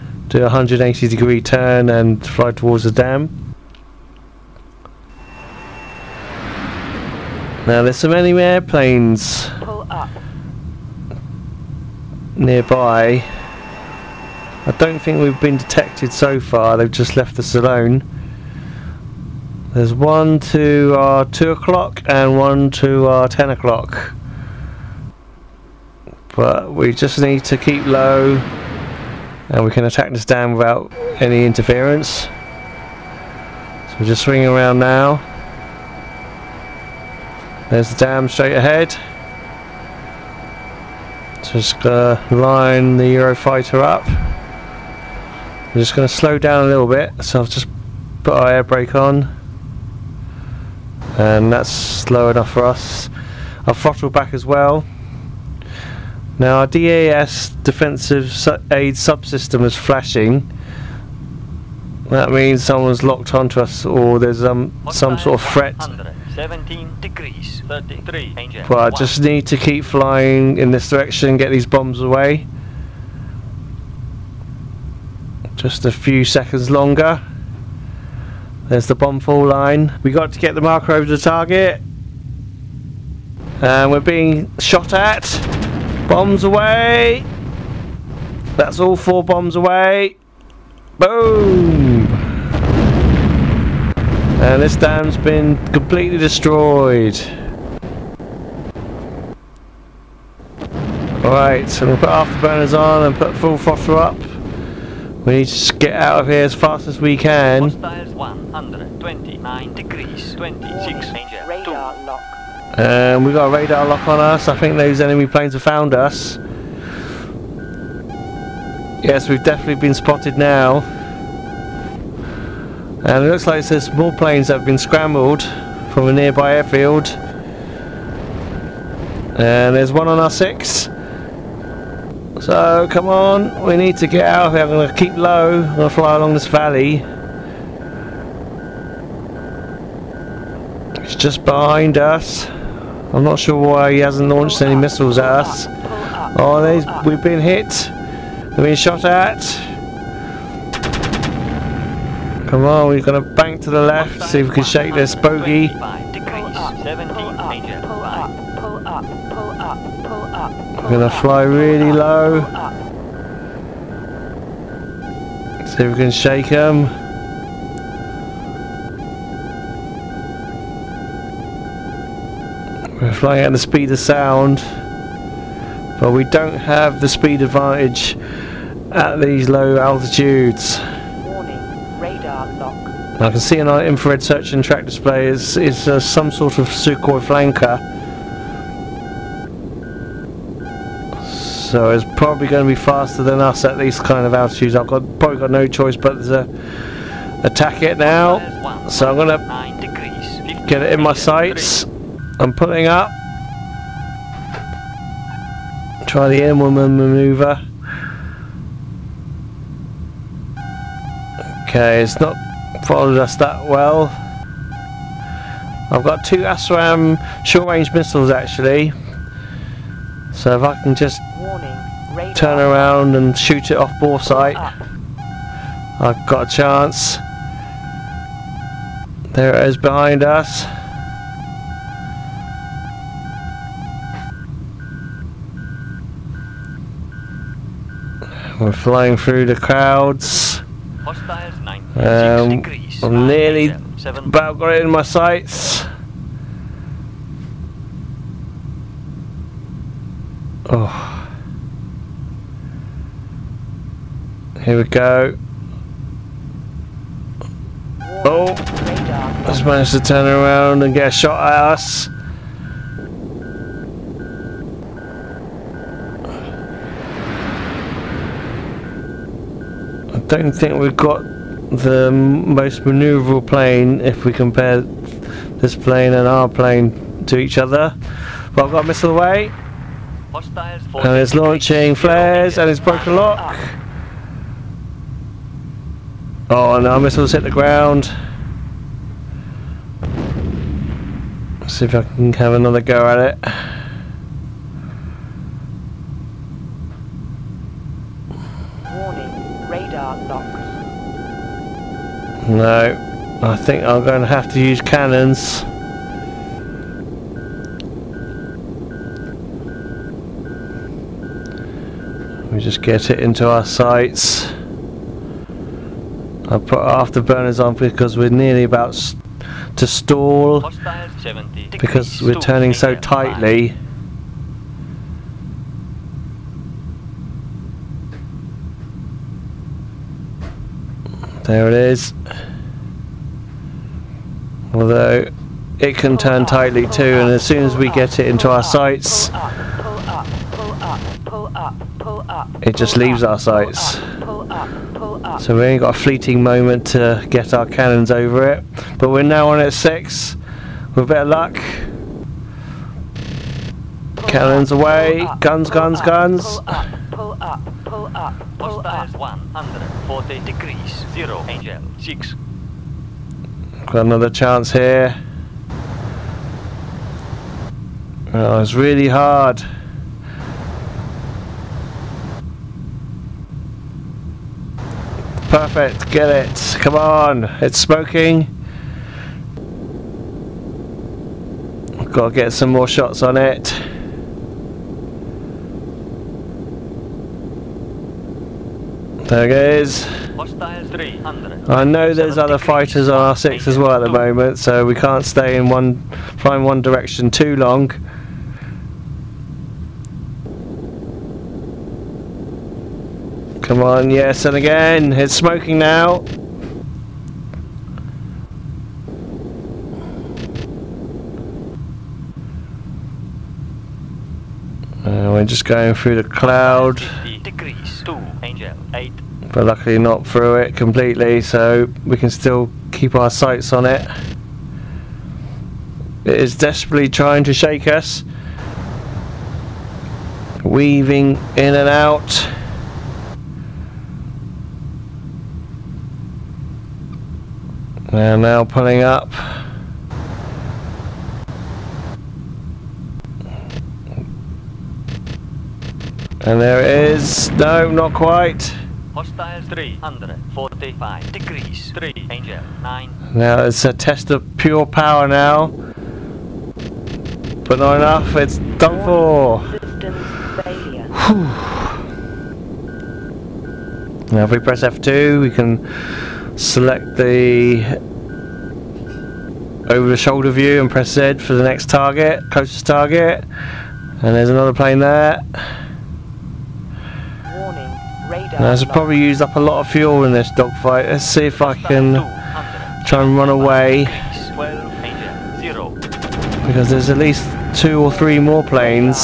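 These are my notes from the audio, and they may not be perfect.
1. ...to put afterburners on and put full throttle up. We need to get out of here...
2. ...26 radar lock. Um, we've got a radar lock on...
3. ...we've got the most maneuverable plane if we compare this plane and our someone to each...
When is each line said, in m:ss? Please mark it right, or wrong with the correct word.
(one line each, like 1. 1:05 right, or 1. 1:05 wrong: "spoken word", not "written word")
1. 1:42 right
2. 1:50 right
3. 4:30 wrong: "plane", not "someone".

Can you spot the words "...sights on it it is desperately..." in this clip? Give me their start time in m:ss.
7:03.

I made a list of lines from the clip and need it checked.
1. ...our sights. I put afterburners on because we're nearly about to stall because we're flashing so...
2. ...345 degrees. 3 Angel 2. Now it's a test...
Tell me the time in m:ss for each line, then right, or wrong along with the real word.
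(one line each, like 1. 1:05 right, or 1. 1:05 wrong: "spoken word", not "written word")
1. 5:13 wrong: "turning", not "flashing"
2. 7:29 wrong: "9", not "2".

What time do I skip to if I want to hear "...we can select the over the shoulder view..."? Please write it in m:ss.
7:45.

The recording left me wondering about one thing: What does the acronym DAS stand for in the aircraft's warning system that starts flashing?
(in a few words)
Defensive aid subsystem.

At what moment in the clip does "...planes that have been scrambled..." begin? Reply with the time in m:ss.
2:04.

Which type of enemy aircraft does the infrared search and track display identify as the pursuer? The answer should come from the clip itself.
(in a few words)
Sukhoi Flanker.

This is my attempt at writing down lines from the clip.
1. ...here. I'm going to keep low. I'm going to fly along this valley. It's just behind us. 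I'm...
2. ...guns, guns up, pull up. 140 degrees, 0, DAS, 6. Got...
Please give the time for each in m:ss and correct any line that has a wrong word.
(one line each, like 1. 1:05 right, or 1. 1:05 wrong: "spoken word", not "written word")
1. 2:14 right
2. 5:55 wrong: "Angel", not "DAS".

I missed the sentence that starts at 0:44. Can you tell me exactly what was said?
I'm just gonna slow down a little bit, so I've just put our air brake on.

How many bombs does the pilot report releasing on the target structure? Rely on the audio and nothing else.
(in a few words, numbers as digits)
4.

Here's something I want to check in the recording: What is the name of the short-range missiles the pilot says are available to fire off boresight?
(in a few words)
ASRAAM.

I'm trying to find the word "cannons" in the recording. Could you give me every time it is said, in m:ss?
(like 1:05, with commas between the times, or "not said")
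5:04, 5:47, 5:54.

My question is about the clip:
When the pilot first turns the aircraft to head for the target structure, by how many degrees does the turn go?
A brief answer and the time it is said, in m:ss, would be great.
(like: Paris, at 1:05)
180, at 0:00.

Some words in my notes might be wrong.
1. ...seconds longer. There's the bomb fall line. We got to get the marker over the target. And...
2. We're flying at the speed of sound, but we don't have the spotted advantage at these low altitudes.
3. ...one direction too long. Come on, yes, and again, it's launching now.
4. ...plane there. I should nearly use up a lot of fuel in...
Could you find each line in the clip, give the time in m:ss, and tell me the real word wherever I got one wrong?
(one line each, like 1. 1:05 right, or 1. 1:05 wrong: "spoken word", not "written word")
1. 1:16 right
2. 2:53 wrong: "speed", not "spotted"
3. 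6:36 wrong: "smoking", not "launching"
4. 7:54 wrong: "probably", not "nearly".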